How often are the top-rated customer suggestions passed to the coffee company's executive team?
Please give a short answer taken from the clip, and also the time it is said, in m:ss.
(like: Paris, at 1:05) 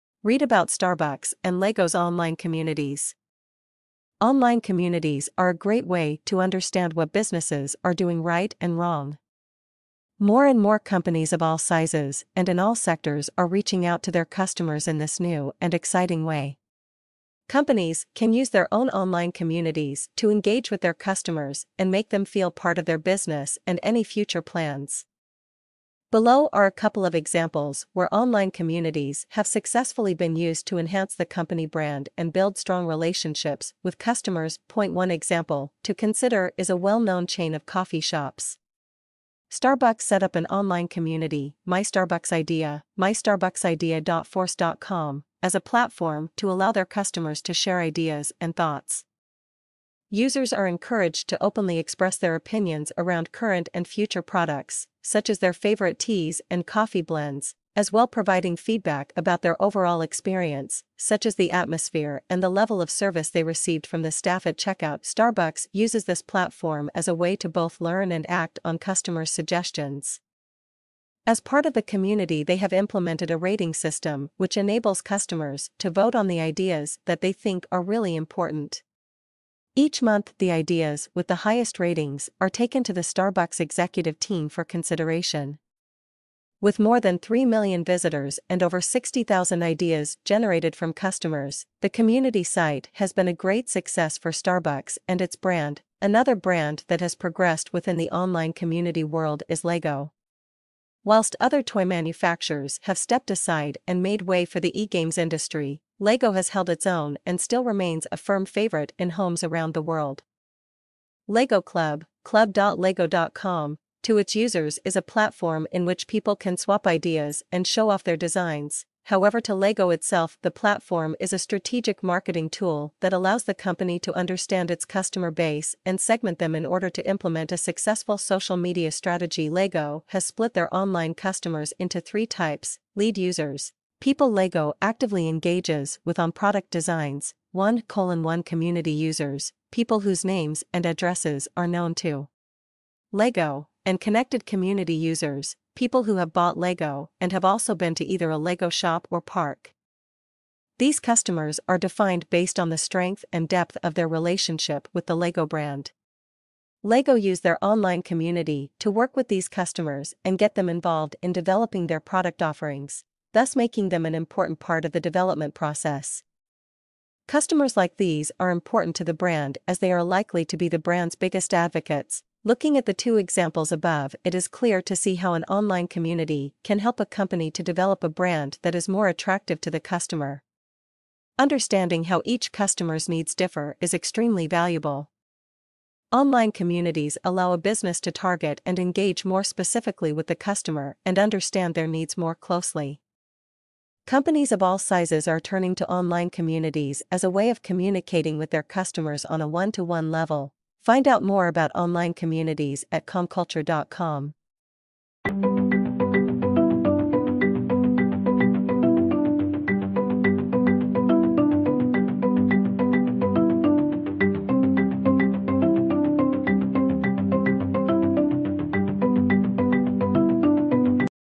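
Each month, at 1:19.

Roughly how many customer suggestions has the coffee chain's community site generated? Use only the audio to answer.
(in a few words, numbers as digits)
Over 60,000.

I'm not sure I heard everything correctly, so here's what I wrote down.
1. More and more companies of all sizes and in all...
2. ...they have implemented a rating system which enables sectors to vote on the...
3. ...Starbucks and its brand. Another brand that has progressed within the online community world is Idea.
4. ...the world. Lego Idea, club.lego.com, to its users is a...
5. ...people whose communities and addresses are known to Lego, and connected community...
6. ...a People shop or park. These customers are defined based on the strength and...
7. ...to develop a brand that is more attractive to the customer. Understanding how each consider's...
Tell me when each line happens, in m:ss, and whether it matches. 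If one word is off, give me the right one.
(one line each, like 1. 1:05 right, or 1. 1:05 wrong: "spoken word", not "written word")
1. 0:10 right
2. 1:12 wrong: "customers", not "sectors"
3. 1:34 wrong: "Lego", not "Idea"
4. 1:49 wrong: "Club", not "Idea"
5. 2:19 wrong: "names", not "communities"
6. 2:28 wrong: "Lego", not "People"
7. 2:57 wrong: "customer", not "consider".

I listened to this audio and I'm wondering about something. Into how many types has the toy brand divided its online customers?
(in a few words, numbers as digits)
3.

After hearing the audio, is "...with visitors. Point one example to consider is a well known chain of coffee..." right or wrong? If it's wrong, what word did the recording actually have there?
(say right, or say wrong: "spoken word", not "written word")
wrong: "customers", not "visitors".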